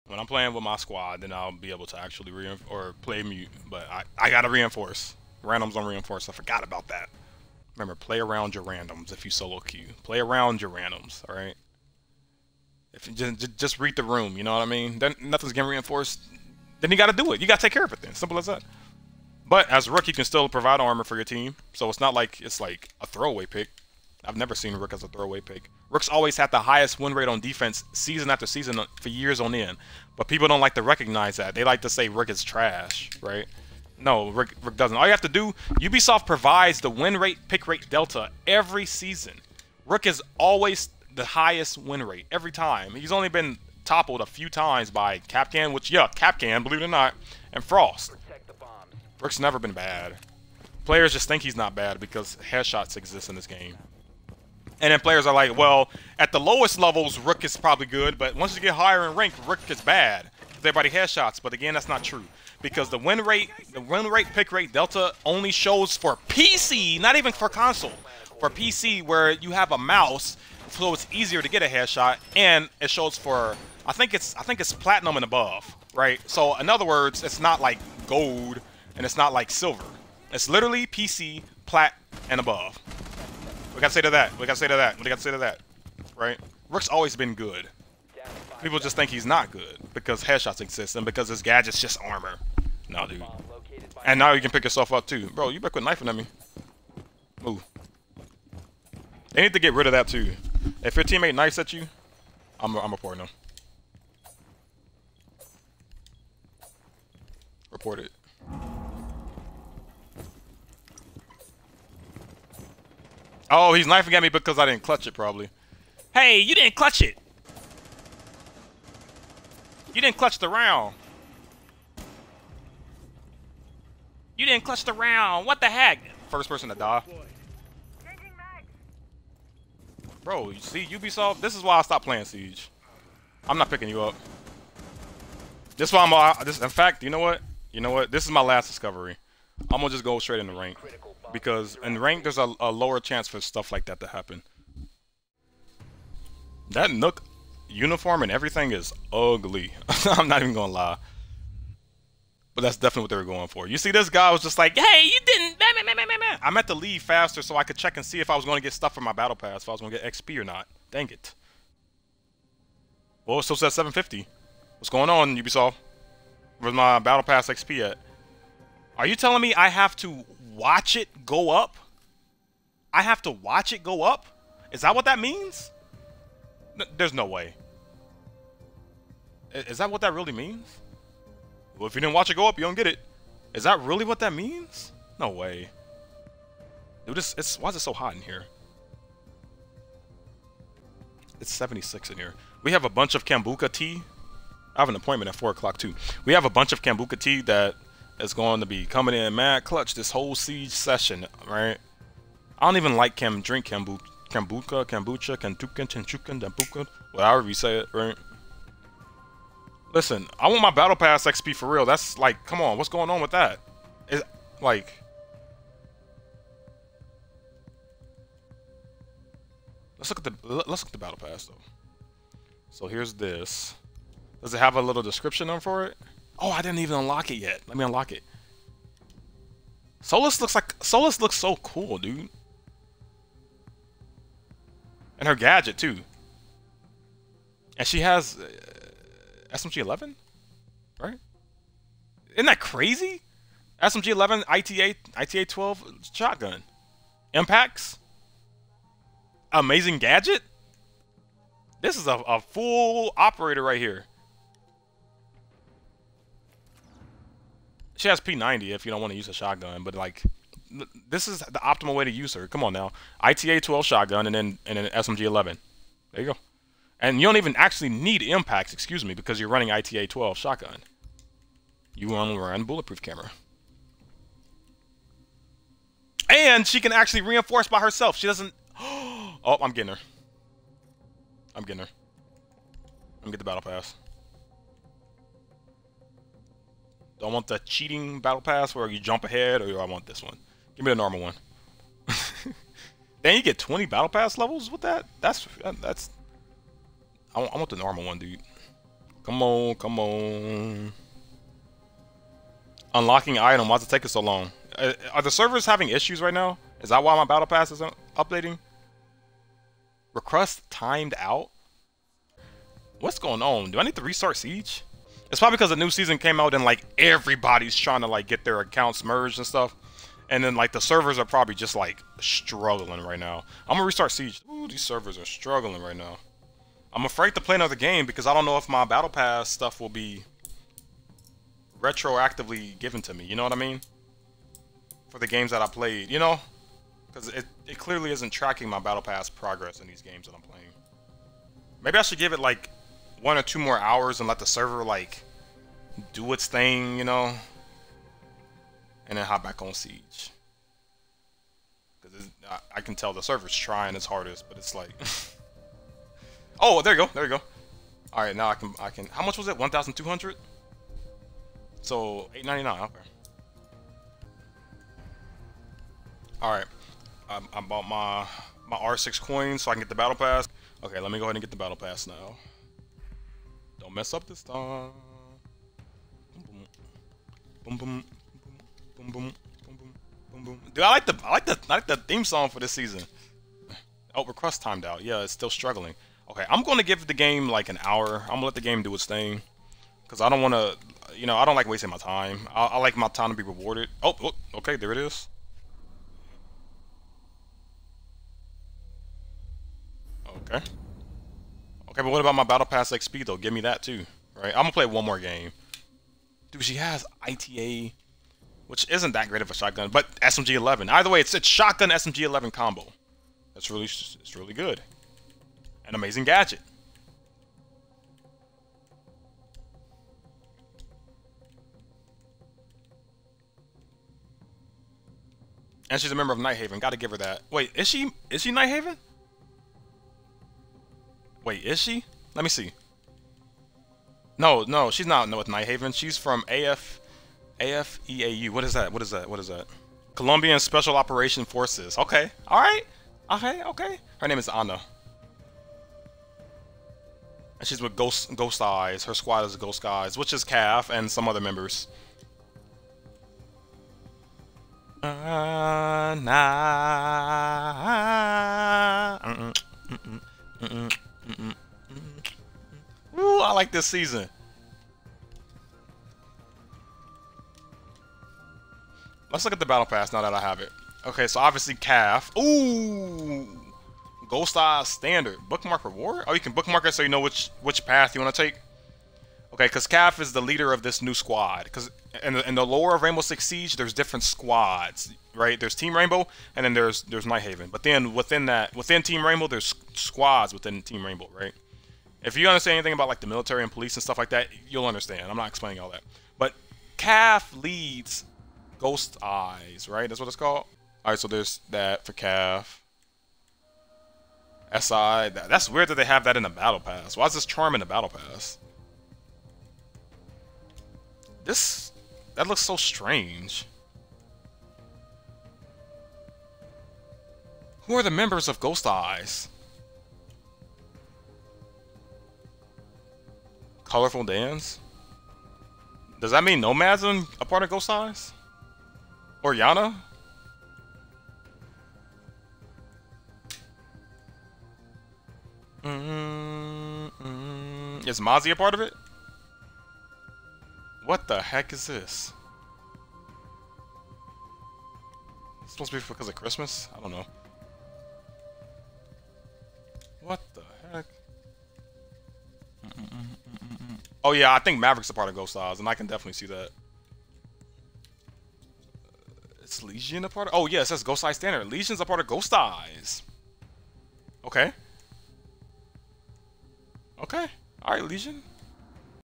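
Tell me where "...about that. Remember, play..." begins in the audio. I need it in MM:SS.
00:06.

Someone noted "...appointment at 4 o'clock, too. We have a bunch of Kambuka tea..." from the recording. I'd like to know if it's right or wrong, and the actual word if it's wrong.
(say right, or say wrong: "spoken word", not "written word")
right.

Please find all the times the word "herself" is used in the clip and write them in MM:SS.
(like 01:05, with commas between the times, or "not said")
04:37.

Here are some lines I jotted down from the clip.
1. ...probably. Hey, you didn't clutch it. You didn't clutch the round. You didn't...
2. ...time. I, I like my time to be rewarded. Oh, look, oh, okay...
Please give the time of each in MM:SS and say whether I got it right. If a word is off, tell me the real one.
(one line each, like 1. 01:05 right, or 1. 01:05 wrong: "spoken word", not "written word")
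1. 01:55 right
2. 06:31 right.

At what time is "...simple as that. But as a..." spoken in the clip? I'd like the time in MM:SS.
00:18.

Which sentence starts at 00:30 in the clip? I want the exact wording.
But people don't like to recognize that.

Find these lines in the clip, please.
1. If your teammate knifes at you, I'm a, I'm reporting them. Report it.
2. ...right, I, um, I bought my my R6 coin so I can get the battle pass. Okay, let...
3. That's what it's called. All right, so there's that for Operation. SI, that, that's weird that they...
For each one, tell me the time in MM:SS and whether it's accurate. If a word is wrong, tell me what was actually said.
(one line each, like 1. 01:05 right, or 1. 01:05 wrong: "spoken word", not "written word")
1. 01:40 right
2. 06:06 right
3. 08:20 wrong: "Cav", not "Operation".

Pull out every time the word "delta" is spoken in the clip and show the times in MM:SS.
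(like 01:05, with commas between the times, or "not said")
00:37, 01:04.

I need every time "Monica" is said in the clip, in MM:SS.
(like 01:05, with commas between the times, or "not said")
not said.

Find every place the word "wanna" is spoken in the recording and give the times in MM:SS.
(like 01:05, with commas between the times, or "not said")
06:30.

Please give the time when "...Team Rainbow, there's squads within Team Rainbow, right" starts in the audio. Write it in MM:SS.
08:09.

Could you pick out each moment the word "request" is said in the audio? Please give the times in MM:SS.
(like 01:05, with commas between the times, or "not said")
05:10, 06:24.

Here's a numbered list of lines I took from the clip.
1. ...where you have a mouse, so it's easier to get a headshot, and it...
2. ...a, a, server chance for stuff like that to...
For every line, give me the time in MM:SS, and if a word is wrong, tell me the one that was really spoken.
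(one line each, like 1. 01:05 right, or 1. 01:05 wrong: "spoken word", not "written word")
1. 01:09 right
2. 02:22 wrong: "lower", not "server".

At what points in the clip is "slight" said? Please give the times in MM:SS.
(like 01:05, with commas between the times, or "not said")
not said.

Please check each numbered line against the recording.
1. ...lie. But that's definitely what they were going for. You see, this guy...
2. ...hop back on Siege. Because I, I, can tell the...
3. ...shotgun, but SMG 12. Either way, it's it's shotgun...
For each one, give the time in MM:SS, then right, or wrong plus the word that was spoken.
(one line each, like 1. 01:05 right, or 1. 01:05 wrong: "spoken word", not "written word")
1. 02:30 right
2. 05:49 right
3. 06:49 wrong: "11", not "12".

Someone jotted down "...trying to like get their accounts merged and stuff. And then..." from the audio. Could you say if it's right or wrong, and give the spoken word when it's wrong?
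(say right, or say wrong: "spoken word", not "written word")
right.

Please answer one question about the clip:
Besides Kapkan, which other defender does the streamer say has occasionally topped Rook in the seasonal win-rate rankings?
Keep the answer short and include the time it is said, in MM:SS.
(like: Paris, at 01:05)
Frost, at 00:47.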